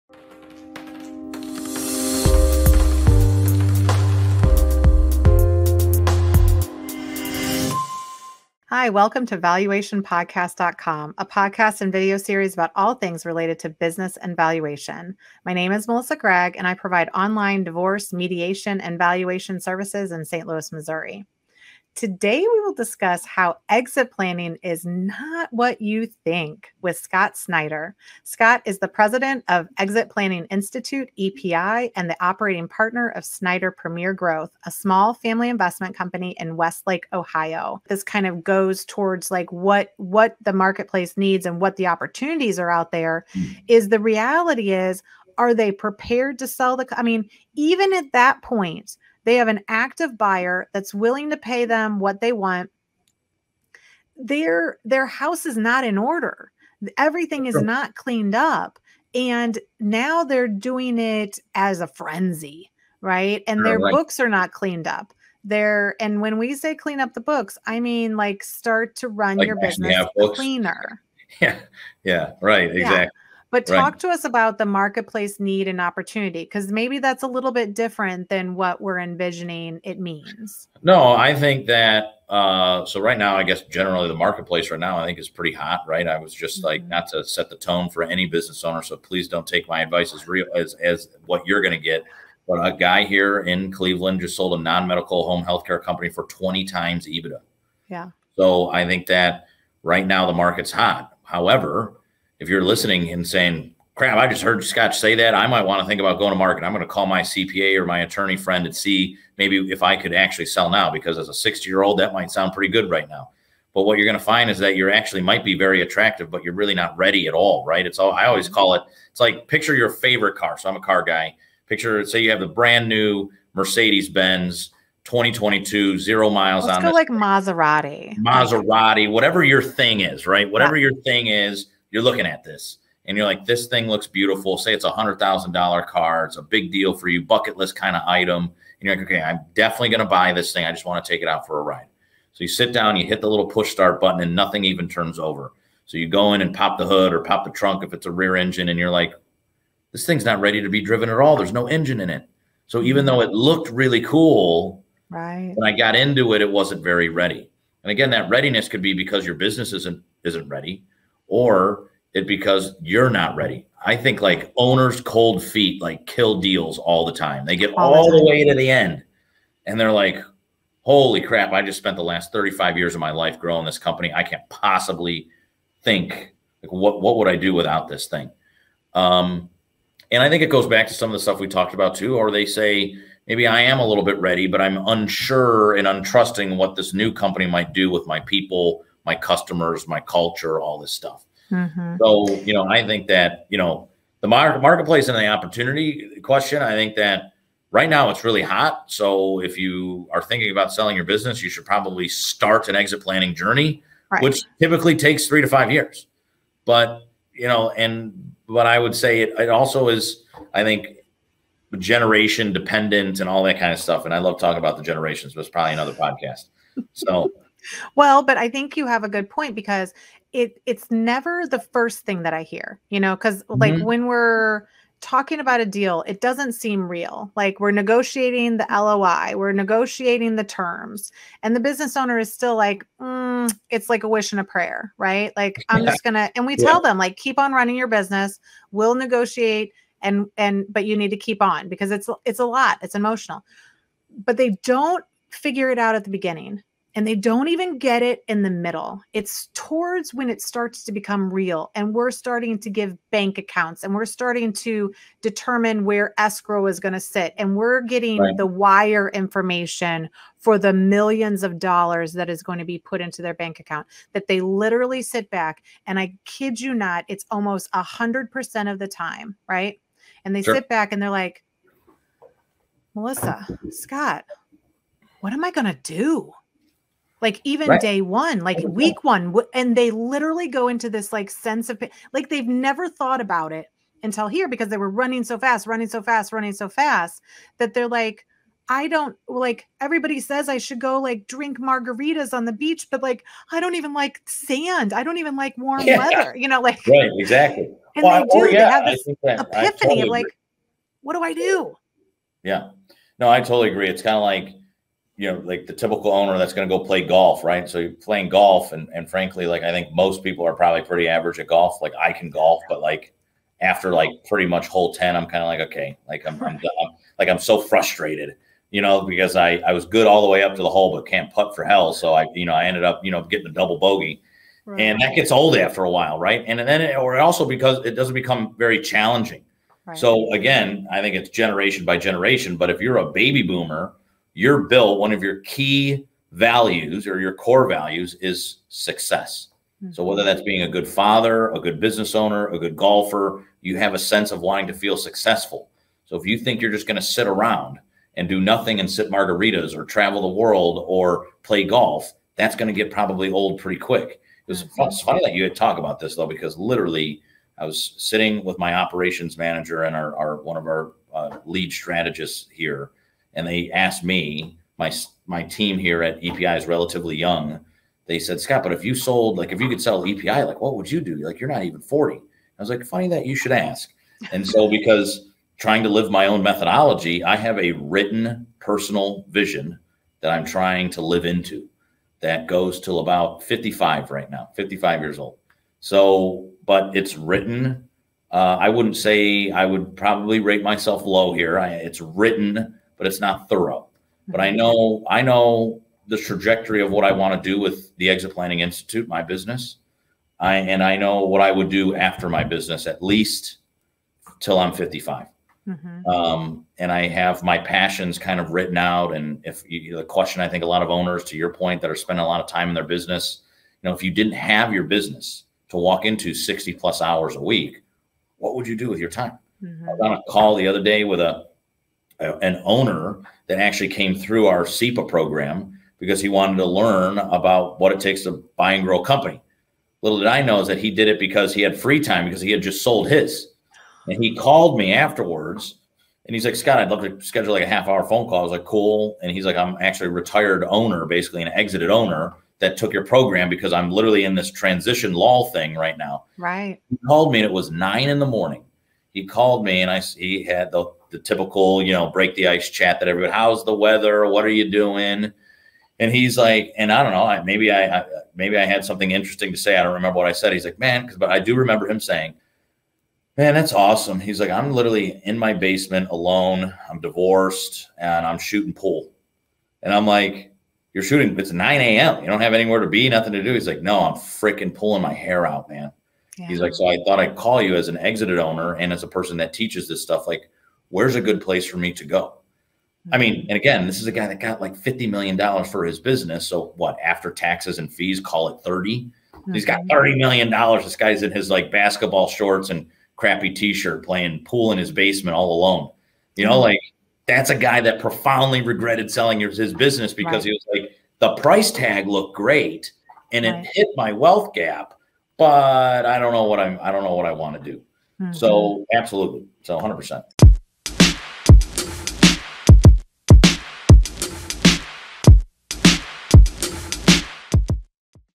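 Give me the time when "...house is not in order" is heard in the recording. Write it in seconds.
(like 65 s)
55 s.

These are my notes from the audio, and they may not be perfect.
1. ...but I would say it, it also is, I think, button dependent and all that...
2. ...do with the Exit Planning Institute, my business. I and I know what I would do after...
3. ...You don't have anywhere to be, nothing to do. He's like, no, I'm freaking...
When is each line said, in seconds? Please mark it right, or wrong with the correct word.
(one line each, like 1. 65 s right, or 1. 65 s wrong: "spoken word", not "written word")
1. 208 s wrong: "generation", not "button"
2. 397 s right
3. 472 s right.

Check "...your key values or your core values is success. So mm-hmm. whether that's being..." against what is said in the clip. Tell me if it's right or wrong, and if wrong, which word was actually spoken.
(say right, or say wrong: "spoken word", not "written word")
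right.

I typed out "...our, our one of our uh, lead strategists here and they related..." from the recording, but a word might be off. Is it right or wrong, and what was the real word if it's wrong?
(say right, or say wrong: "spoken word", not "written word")
wrong: "asked", not "related".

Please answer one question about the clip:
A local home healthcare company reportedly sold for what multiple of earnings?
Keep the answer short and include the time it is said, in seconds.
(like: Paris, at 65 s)
20 times EBITDA, at 96 s.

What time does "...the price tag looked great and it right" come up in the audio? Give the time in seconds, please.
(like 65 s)
501 s.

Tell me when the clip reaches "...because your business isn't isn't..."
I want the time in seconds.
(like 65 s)
158 s.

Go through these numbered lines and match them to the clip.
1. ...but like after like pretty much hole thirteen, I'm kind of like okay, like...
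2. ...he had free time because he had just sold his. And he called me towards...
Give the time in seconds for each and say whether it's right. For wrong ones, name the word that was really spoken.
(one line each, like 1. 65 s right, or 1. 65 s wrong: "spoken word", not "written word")
1. 312 s wrong: "ten", not "thirteen"
2. 431 s wrong: "afterwards", not "towards".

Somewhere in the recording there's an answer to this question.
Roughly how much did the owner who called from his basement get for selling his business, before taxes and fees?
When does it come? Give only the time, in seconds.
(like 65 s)
484 s.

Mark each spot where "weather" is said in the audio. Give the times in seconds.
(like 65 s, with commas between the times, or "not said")
295 s, 453 s.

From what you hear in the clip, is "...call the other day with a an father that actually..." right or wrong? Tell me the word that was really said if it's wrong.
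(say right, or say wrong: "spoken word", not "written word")
wrong: "owner", not "father".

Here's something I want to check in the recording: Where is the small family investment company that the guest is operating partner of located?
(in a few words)
Westlake, Ohio.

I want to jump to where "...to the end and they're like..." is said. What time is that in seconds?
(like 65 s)
168 s.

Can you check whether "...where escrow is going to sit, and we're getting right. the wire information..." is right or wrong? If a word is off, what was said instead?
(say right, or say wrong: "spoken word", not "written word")
right.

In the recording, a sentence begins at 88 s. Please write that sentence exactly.
So please don't take my advice as real as, as what you're going to get.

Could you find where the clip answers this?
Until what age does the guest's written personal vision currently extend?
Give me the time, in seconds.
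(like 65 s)
384 s.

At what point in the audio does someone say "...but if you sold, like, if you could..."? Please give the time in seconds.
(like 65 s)
368 s.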